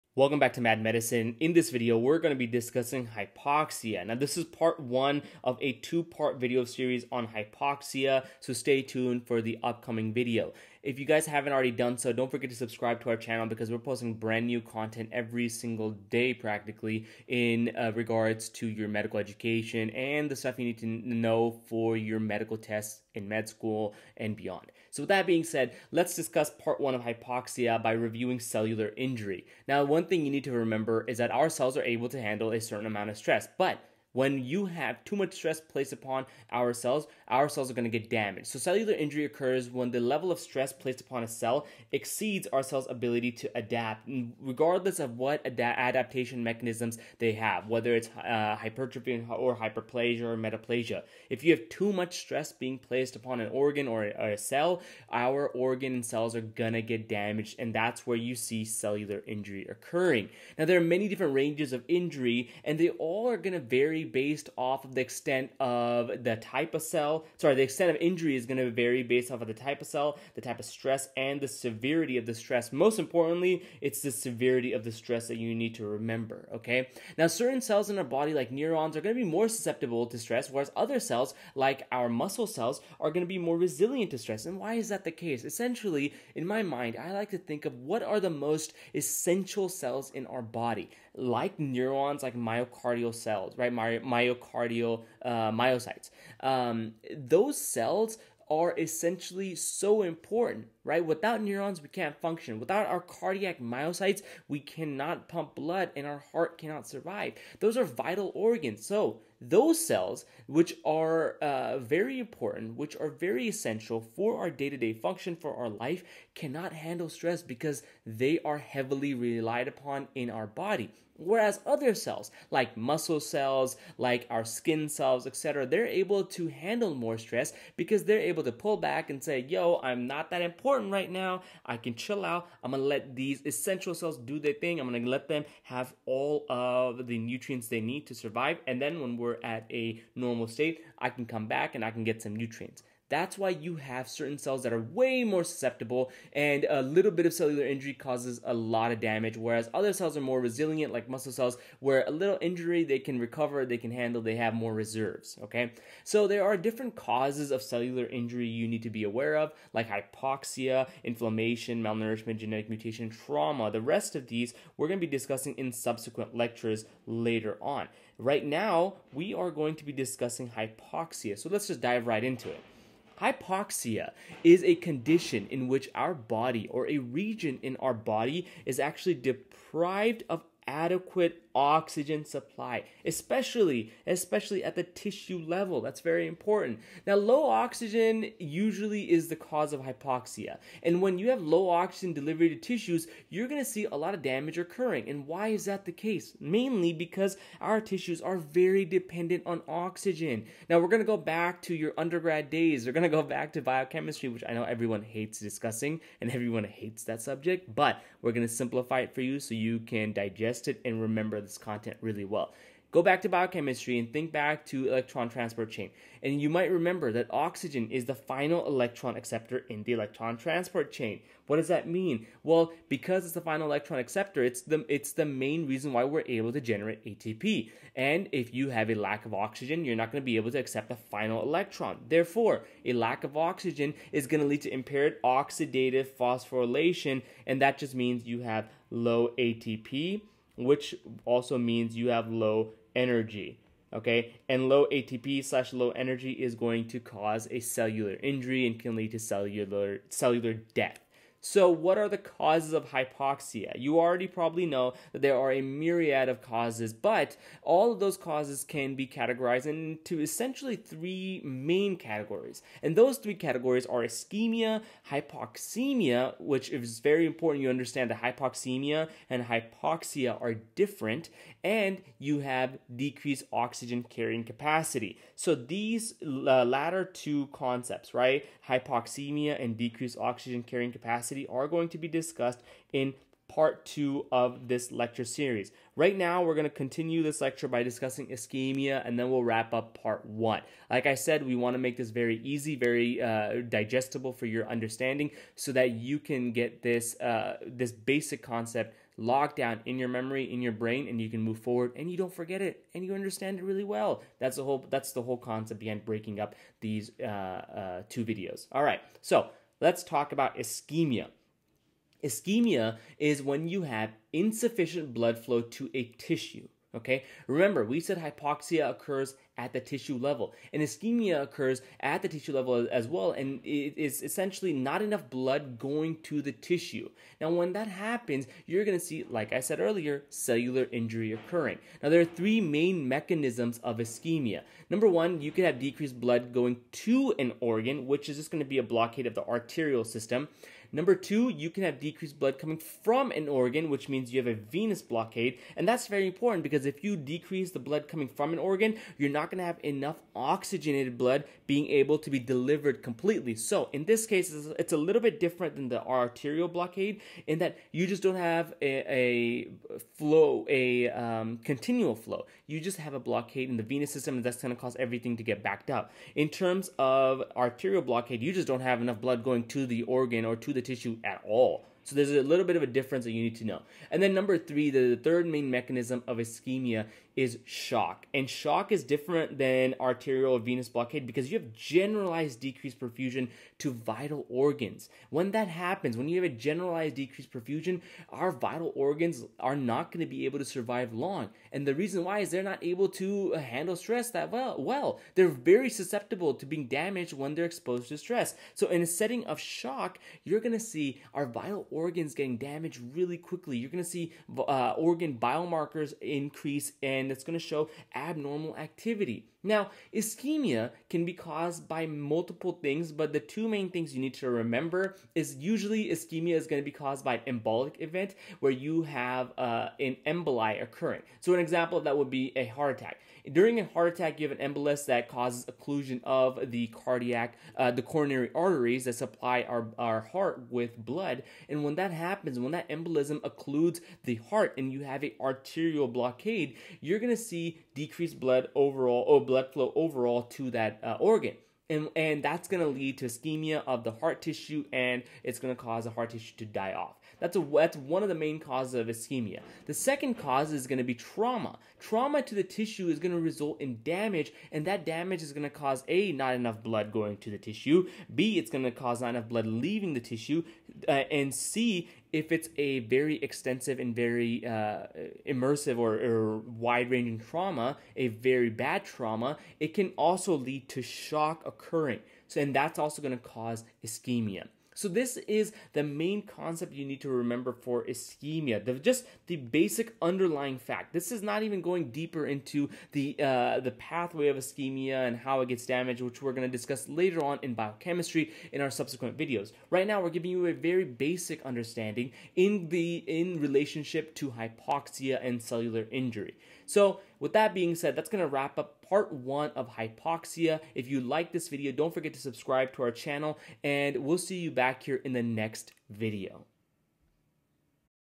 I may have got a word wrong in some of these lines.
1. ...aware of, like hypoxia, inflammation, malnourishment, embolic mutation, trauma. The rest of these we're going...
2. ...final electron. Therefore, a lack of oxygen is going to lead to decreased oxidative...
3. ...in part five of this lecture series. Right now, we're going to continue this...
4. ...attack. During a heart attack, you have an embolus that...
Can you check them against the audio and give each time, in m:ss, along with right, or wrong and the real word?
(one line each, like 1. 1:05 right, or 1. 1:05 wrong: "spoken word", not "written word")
1. 2:39 wrong: "genetic", not "embolic"
2. 3:50 wrong: "impaired", not "decreased"
3. 4:42 wrong: "two", not "five"
4. 7:02 right.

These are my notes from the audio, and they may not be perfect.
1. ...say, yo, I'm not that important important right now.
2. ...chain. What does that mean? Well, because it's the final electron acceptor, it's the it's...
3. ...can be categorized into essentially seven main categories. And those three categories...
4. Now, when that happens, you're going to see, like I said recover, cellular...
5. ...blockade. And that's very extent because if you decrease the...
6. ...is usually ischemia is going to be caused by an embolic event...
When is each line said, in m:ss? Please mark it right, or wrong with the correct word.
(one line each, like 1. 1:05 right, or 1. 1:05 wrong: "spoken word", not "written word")
1. 2:09 right
2. 3:40 right
3. 4:18 wrong: "three", not "seven"
4. 5:27 wrong: "earlier", not "recover"
5. 5:45 wrong: "important", not "extent"
6. 6:55 right.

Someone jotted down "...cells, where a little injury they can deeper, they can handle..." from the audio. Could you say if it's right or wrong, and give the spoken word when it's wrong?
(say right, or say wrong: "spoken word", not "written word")
wrong: "recover", not "deeper".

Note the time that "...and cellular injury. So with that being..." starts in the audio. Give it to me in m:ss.
8:15.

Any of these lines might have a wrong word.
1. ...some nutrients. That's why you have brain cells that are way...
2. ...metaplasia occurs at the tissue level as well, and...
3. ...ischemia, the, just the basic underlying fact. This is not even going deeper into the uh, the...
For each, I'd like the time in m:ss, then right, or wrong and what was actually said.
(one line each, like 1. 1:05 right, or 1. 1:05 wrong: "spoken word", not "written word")
1. 2:22 wrong: "certain", not "brain"
2. 5:20 wrong: "ischemia", not "metaplasia"
3. 7:58 right.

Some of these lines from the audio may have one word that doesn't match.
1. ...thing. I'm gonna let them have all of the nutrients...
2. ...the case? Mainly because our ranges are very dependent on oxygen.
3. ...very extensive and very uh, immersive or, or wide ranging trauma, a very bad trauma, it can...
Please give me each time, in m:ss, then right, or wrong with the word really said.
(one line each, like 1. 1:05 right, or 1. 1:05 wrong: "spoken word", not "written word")
1. 2:14 right
2. 3:15 wrong: "tissues", not "ranges"
3. 7:42 right.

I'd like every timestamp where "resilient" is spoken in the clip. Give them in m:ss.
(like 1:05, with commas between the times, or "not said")
1:23, 2:30.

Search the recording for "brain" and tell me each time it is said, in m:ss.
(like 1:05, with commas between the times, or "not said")
5:00.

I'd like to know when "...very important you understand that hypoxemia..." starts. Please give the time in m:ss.
4:26.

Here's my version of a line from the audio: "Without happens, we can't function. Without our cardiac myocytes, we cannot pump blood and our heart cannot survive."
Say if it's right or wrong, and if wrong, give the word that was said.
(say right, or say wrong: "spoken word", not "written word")
wrong: "neurons", not "happens".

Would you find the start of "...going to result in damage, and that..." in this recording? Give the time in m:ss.
7:33.